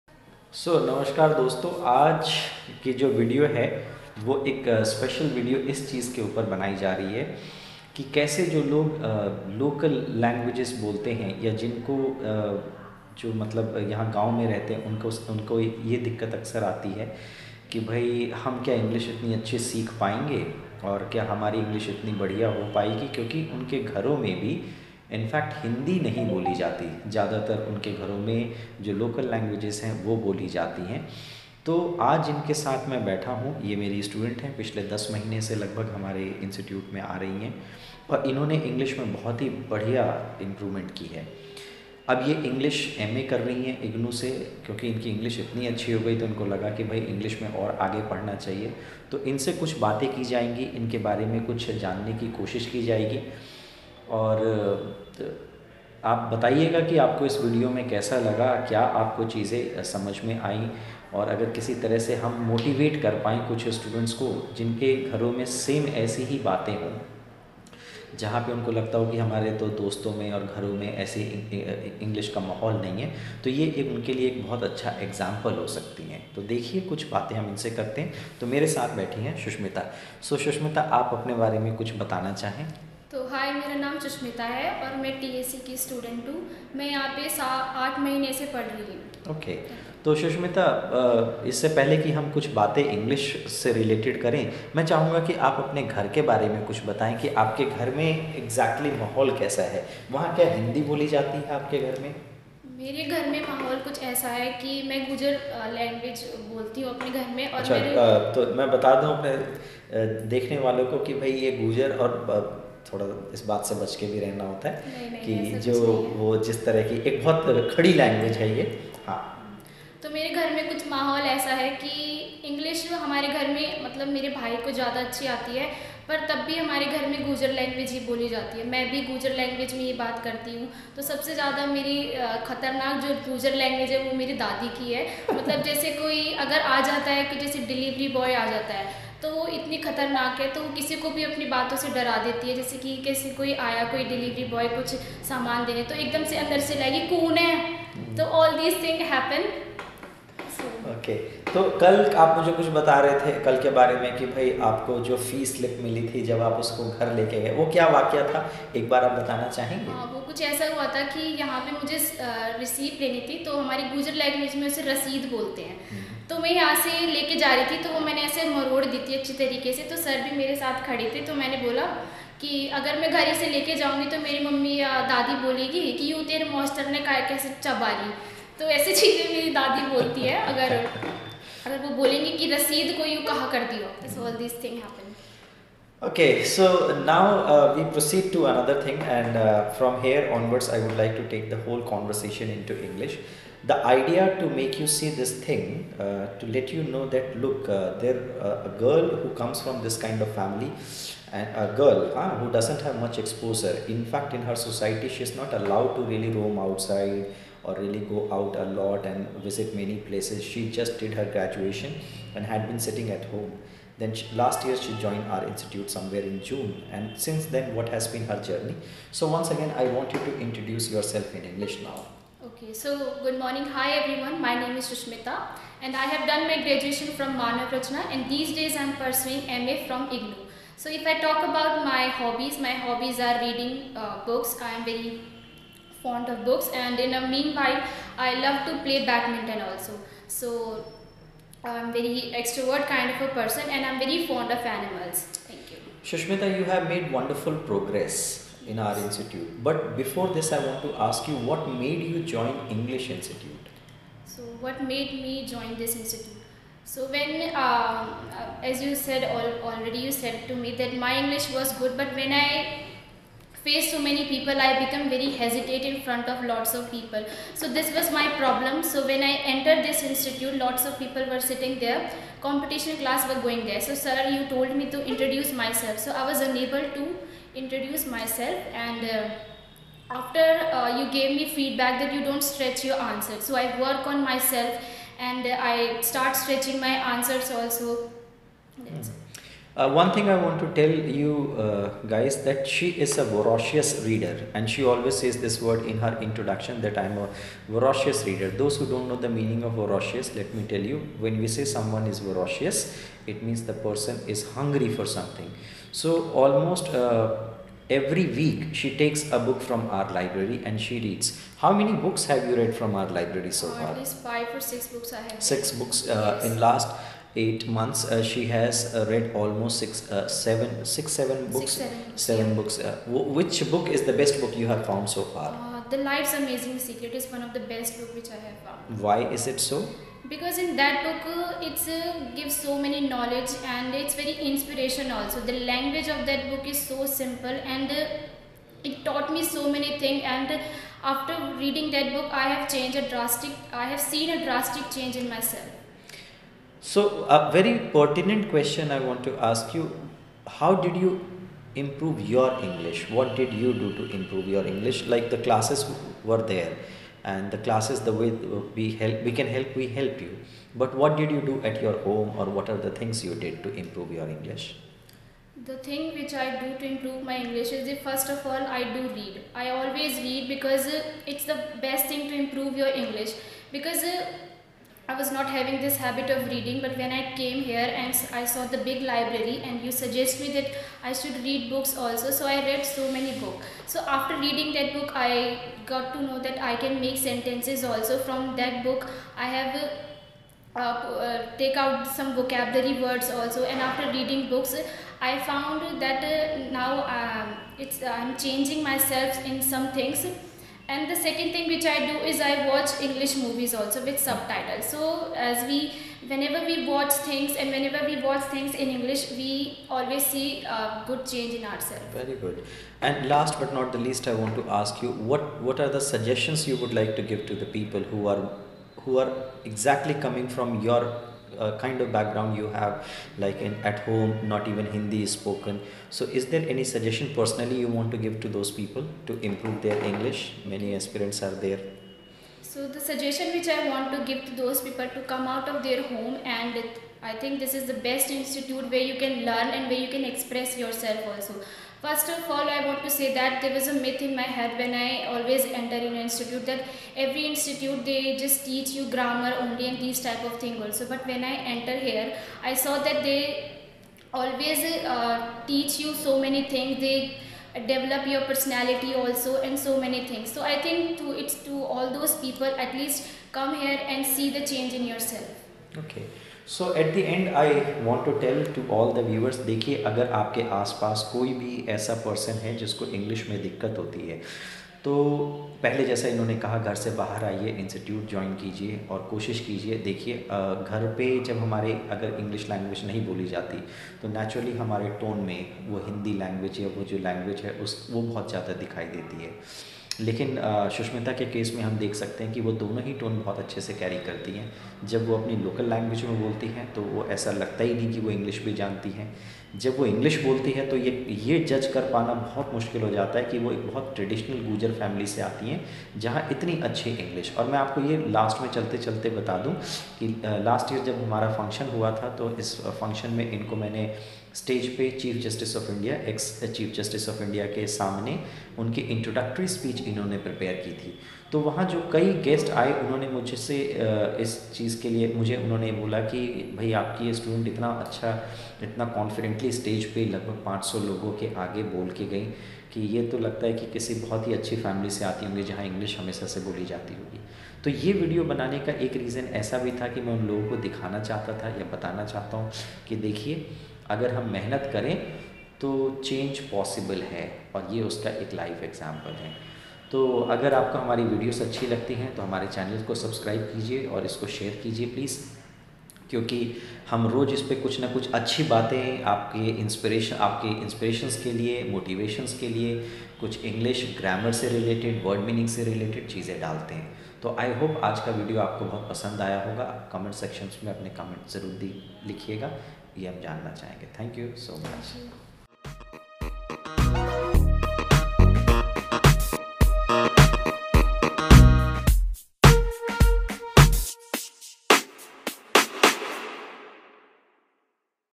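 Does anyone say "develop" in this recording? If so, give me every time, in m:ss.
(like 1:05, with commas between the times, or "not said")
7:37.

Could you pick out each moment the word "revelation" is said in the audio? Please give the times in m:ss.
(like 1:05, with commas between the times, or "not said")
not said.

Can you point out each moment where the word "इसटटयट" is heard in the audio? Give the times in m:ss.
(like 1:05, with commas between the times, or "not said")
0:36, 7:57.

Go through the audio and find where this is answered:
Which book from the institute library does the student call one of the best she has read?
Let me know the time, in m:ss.
5:25.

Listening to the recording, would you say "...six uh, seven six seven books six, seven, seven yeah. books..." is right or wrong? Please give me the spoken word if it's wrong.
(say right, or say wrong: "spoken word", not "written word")
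right.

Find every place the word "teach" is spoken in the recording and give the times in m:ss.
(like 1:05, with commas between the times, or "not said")
7:28, 7:35.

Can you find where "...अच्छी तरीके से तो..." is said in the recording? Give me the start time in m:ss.
2:49.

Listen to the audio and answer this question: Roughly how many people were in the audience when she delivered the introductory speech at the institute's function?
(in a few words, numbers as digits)
500.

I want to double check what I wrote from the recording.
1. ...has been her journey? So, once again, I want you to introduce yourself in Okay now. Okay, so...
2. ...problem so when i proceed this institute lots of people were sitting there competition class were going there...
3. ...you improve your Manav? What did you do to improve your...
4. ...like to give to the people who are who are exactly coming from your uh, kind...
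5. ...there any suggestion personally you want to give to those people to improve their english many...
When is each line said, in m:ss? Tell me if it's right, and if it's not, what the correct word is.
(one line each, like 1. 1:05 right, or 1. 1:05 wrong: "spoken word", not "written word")
1. 3:37 wrong: "English", not "Okay"
2. 4:28 wrong: "entered", not "proceed"
3. 5:50 wrong: "English", not "Manav"
4. 6:57 right
5. 7:06 right.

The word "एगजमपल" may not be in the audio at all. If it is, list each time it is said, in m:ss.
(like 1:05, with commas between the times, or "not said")
1:15, 9:08.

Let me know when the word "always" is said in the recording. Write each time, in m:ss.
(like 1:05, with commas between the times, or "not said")
4:54, 6:09, 6:49, 7:25, 7:34.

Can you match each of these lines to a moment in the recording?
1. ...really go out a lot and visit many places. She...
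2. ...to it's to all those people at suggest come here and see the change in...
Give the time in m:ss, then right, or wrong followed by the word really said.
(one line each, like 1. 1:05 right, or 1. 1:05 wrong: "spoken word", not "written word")
1. 3:27 right
2. 7:41 wrong: "least", not "suggest".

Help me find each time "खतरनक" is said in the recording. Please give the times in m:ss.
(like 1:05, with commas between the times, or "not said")
2:12, 2:19.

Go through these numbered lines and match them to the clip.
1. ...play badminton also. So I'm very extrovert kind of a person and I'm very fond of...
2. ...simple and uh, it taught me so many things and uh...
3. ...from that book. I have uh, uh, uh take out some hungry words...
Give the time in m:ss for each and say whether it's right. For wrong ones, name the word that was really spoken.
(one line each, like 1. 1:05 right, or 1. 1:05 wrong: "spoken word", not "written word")
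1. 3:58 right
2. 5:37 right
3. 6:28 wrong: "vocabulary", not "hungry".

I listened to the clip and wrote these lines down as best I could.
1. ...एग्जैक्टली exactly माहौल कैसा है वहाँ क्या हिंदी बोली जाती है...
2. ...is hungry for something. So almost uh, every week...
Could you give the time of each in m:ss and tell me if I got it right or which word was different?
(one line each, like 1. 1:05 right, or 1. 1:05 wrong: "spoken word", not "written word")
1. 1:38 right
2. 5:04 right.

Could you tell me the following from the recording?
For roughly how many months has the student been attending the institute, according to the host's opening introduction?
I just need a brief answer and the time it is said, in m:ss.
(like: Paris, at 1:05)
10, at 0:34.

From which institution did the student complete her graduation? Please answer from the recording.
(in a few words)
Manav Rachna.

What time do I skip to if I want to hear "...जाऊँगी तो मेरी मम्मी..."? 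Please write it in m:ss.
2:53.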